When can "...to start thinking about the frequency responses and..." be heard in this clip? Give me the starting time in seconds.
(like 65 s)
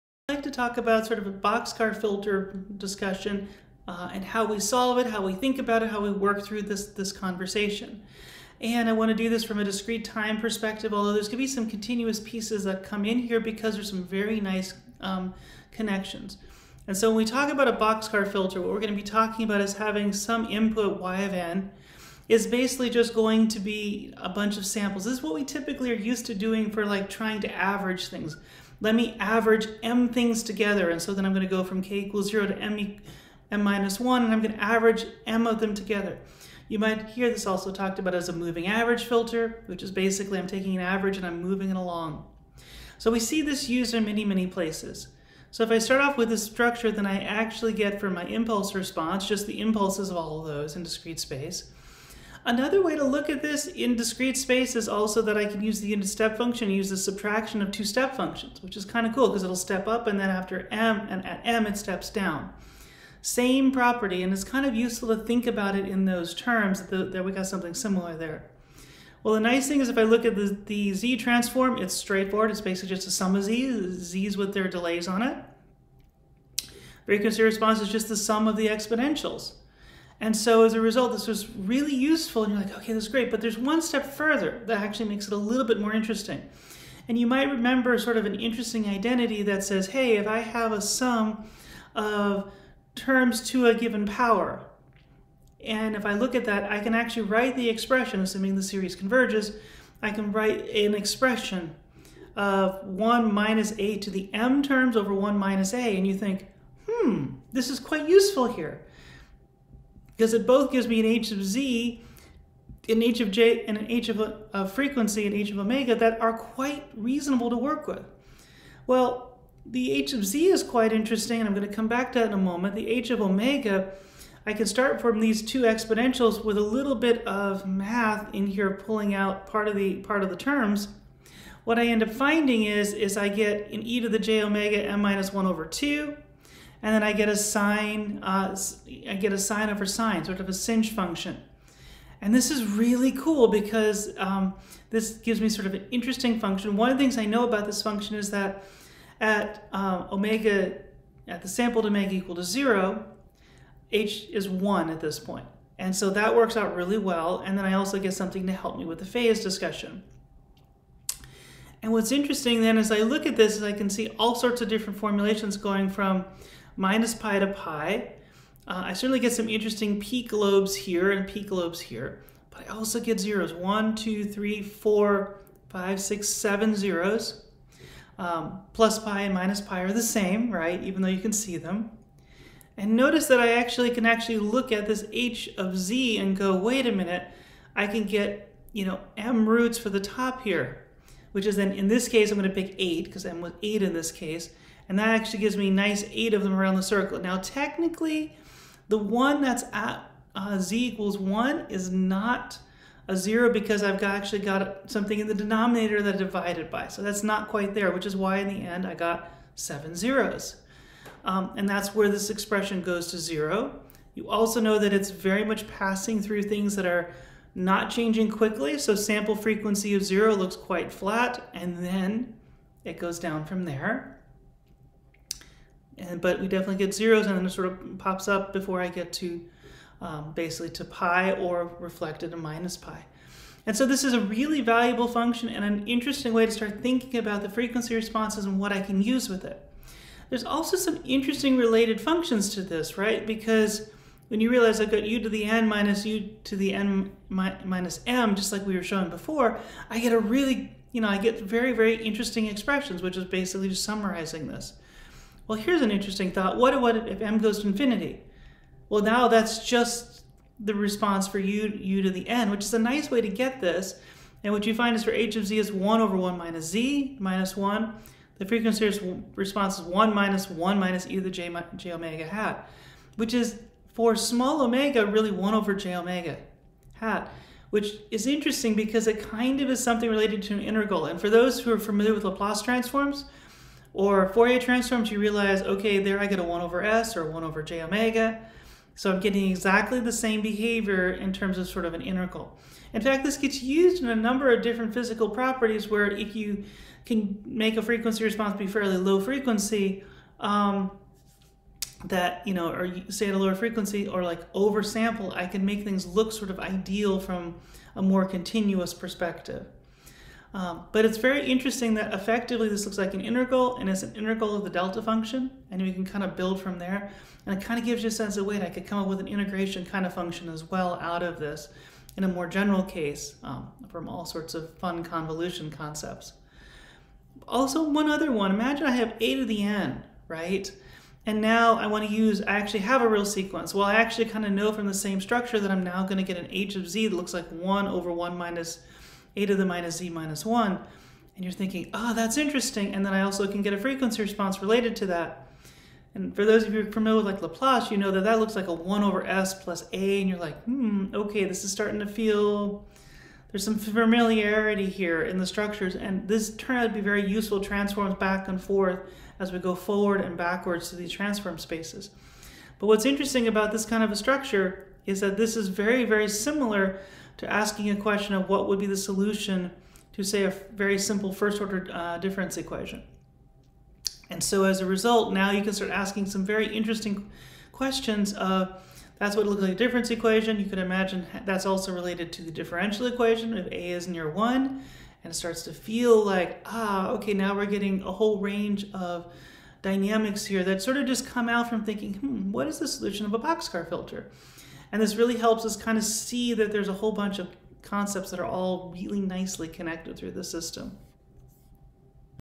236 s.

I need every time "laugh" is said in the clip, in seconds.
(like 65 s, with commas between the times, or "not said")
not said.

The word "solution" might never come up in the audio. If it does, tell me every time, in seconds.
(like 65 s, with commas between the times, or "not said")
368 s, 392 s.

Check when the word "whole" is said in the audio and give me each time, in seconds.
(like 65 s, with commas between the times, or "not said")
388 s, 396 s.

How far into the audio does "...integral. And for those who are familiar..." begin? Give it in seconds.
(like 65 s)
280 s.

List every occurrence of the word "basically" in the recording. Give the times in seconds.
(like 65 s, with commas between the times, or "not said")
22 s, 39 s, 72 s, 230 s, 253 s.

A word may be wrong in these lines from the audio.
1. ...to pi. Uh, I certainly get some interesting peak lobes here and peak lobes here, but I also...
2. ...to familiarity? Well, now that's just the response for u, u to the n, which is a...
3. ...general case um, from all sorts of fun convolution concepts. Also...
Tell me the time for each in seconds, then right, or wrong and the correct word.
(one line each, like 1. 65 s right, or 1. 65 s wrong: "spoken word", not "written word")
1. 167 s right
2. 257 s wrong: "infinity", not "familiarity"
3. 322 s right.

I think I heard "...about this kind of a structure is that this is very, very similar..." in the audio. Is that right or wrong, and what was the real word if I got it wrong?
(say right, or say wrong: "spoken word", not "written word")
right.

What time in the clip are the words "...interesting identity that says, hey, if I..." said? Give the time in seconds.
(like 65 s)
88 s.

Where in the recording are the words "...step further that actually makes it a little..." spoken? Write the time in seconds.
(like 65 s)
83 s.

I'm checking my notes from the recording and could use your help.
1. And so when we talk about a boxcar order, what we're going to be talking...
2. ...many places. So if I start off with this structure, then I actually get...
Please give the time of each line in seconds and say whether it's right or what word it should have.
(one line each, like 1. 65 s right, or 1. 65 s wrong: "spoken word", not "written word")
1. 16 s wrong: "filter", not "order"
2. 44 s right.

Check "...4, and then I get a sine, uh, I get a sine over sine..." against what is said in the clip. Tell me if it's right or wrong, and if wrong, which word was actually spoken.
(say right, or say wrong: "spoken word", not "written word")
wrong: "2", not "4".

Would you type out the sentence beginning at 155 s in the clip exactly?
And so that works out really well.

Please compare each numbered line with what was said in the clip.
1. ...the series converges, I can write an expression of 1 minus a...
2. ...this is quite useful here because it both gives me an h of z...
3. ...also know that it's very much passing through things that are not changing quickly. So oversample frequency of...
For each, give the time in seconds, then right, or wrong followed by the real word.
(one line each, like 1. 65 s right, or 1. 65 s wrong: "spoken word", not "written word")
1. 98 s right
2. 107 s right
3. 214 s wrong: "sample", not "oversample".